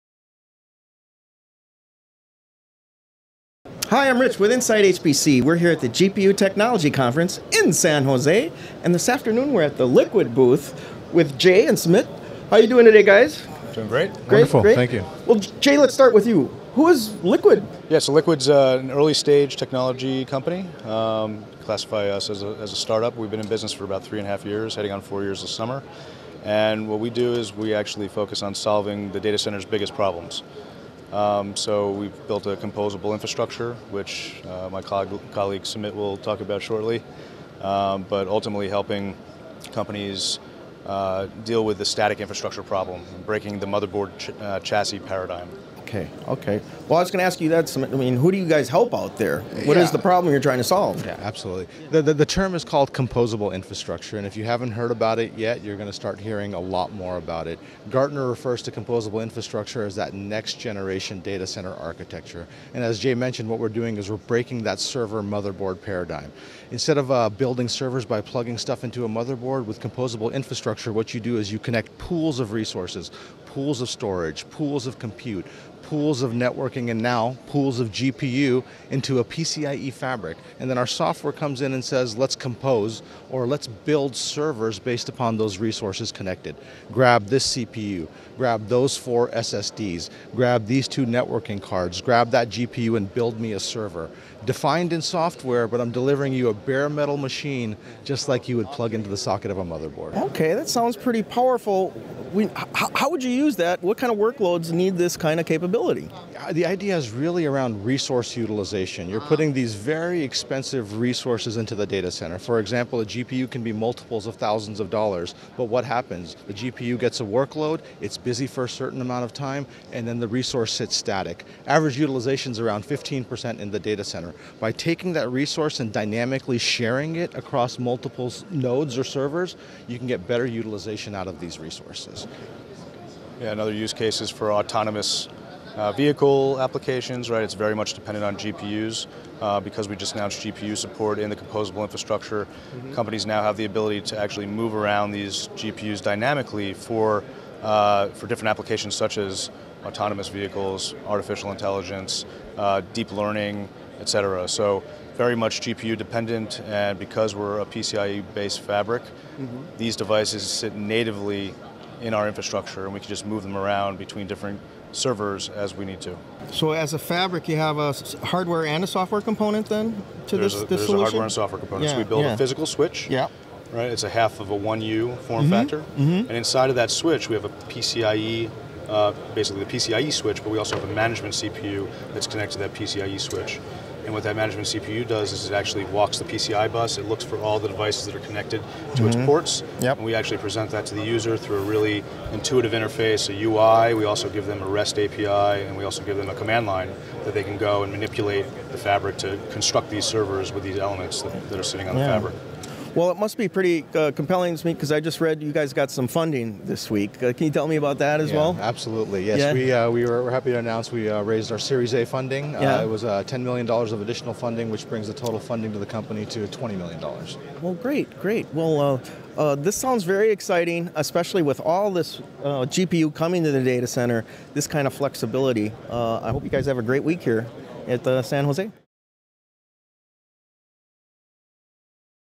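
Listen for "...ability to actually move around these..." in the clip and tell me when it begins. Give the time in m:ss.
2:23.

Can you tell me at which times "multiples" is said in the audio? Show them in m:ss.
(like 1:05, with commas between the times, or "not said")
1:53, 2:07.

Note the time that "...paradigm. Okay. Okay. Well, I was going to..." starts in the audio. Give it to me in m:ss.
0:44.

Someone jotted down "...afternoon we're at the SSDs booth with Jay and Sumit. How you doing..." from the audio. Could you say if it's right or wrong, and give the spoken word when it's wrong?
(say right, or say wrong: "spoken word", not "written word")
wrong: "Liqid", not "SSDs".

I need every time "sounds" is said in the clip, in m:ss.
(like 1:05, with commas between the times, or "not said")
1:40, 3:39.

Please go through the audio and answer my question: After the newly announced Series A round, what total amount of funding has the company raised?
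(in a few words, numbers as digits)
$20 million.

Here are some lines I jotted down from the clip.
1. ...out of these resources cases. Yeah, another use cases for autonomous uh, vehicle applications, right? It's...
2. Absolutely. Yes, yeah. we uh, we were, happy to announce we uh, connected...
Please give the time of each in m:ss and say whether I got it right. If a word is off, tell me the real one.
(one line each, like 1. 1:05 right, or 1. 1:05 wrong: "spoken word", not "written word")
1. 2:11 right
2. 3:28 wrong: "raised", not "connected".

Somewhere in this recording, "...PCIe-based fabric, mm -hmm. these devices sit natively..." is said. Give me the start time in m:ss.
2:37.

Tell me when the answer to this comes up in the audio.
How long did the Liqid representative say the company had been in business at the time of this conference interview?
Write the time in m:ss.
0:24.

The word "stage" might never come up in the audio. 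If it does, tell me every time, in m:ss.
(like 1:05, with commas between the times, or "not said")
0:19.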